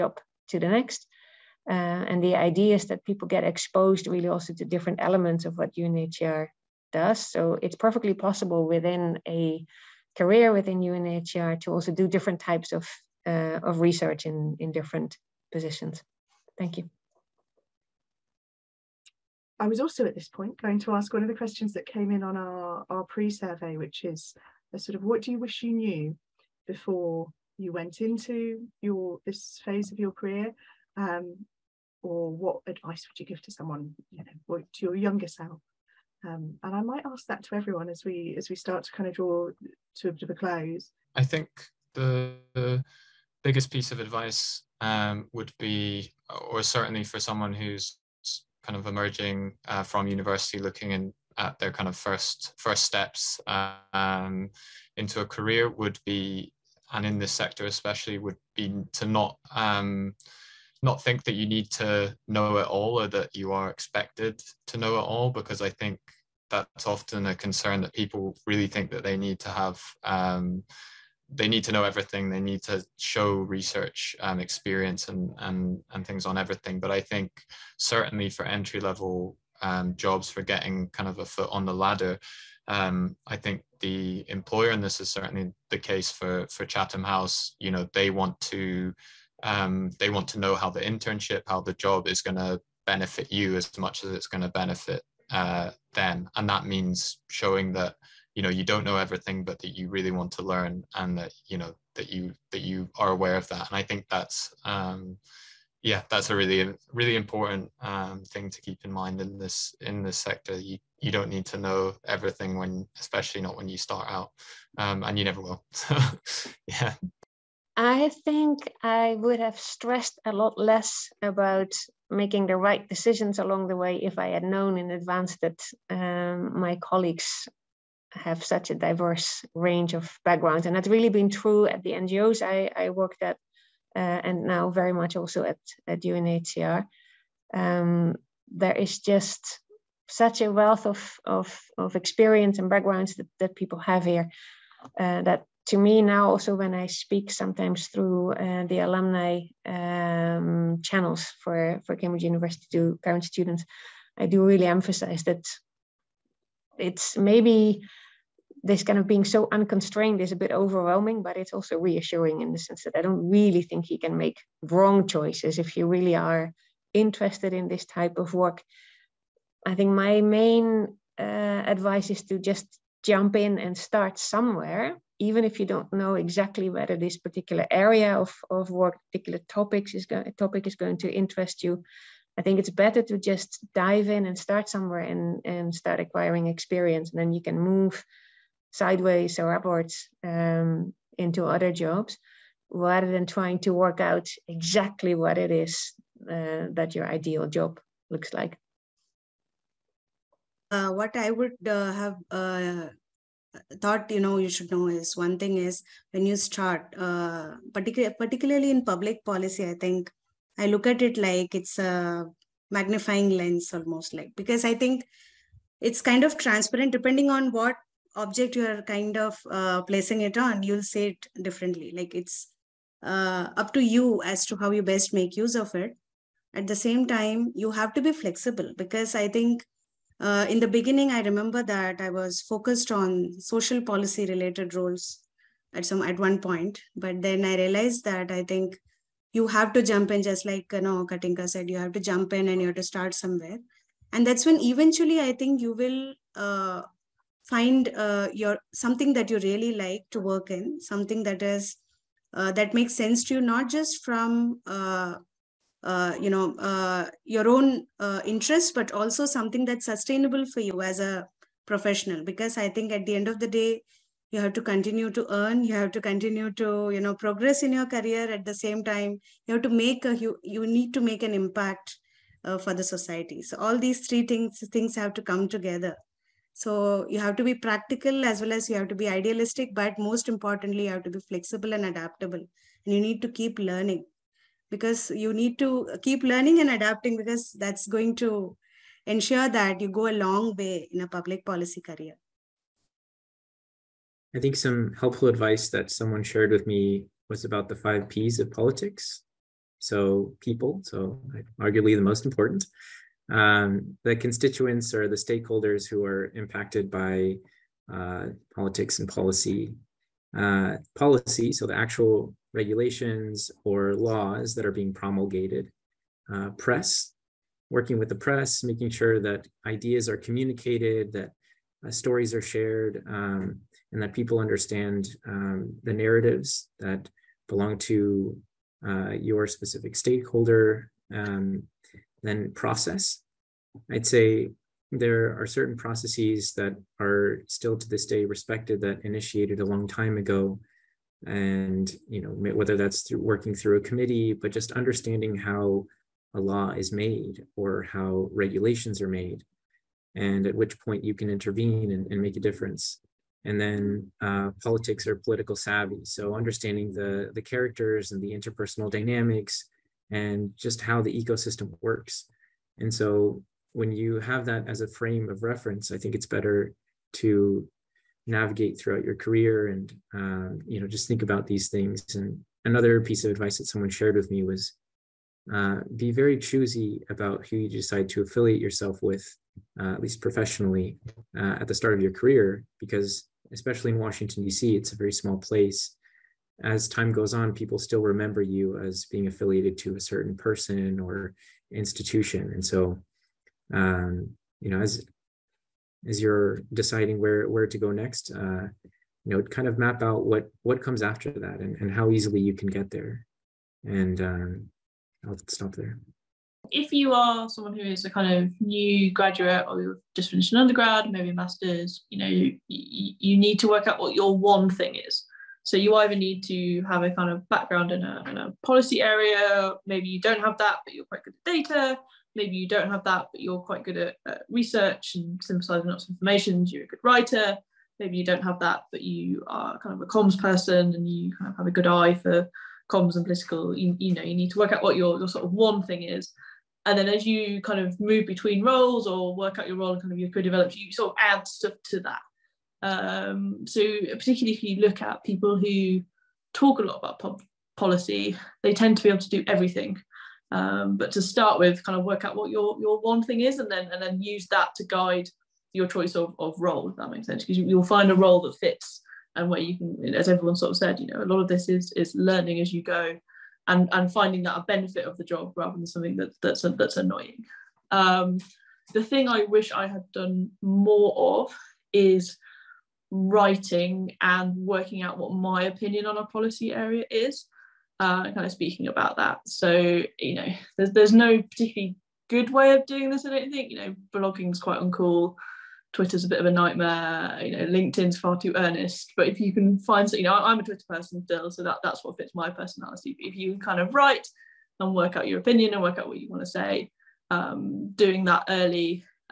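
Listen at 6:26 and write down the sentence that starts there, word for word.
As time goes on, people still remember you as being affiliated to a certain person or institution.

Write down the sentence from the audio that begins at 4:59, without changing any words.
So, people, so arguably the most important.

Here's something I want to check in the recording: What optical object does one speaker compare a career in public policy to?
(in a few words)
magnifying lens.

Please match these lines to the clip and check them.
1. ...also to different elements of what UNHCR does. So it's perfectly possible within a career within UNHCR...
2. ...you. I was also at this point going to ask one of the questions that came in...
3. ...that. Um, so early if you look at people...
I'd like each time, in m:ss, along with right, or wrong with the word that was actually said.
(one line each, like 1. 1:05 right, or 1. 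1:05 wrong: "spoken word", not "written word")
1. 0:04 right
2. 0:16 right
3. 7:21 wrong: "particularly", not "early".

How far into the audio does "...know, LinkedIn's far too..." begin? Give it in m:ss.
8:07.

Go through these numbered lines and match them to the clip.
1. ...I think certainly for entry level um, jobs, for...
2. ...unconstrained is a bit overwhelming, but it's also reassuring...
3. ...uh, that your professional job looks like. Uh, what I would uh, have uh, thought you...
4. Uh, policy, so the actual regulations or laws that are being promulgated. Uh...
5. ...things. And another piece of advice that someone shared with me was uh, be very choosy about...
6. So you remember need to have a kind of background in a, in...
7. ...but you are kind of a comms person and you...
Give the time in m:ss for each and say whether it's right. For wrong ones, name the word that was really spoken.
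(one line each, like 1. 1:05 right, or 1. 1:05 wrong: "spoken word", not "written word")
1. 1:16 right
2. 2:39 right
3. 3:16 wrong: "ideal", not "professional"
4. 5:10 right
5. 6:11 right
6. 6:55 wrong: "either", not "remember"
7. 7:08 right.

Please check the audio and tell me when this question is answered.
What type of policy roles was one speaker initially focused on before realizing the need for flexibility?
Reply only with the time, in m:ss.
3:53.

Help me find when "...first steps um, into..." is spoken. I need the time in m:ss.
0:52.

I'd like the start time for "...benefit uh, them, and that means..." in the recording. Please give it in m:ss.
1:34.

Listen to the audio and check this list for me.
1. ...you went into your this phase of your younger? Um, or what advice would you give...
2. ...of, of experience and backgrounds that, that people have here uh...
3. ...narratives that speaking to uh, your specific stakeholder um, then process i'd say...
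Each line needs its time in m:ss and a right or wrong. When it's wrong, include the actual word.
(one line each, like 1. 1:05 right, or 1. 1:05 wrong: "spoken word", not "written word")
1. 0:27 wrong: "career", not "younger"
2. 2:21 right
3. 5:25 wrong: "belong", not "speaking".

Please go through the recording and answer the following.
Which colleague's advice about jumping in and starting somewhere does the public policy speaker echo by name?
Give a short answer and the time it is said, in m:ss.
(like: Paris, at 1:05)
Katinka, at 4:01.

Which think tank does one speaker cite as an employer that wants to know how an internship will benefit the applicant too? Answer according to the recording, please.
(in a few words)
Chatham House.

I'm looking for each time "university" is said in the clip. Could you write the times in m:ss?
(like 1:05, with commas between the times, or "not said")
0:50, 2:32.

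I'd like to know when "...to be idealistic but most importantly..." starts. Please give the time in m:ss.
4:38.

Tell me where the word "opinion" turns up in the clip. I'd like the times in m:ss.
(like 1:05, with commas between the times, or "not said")
7:55, 8:15.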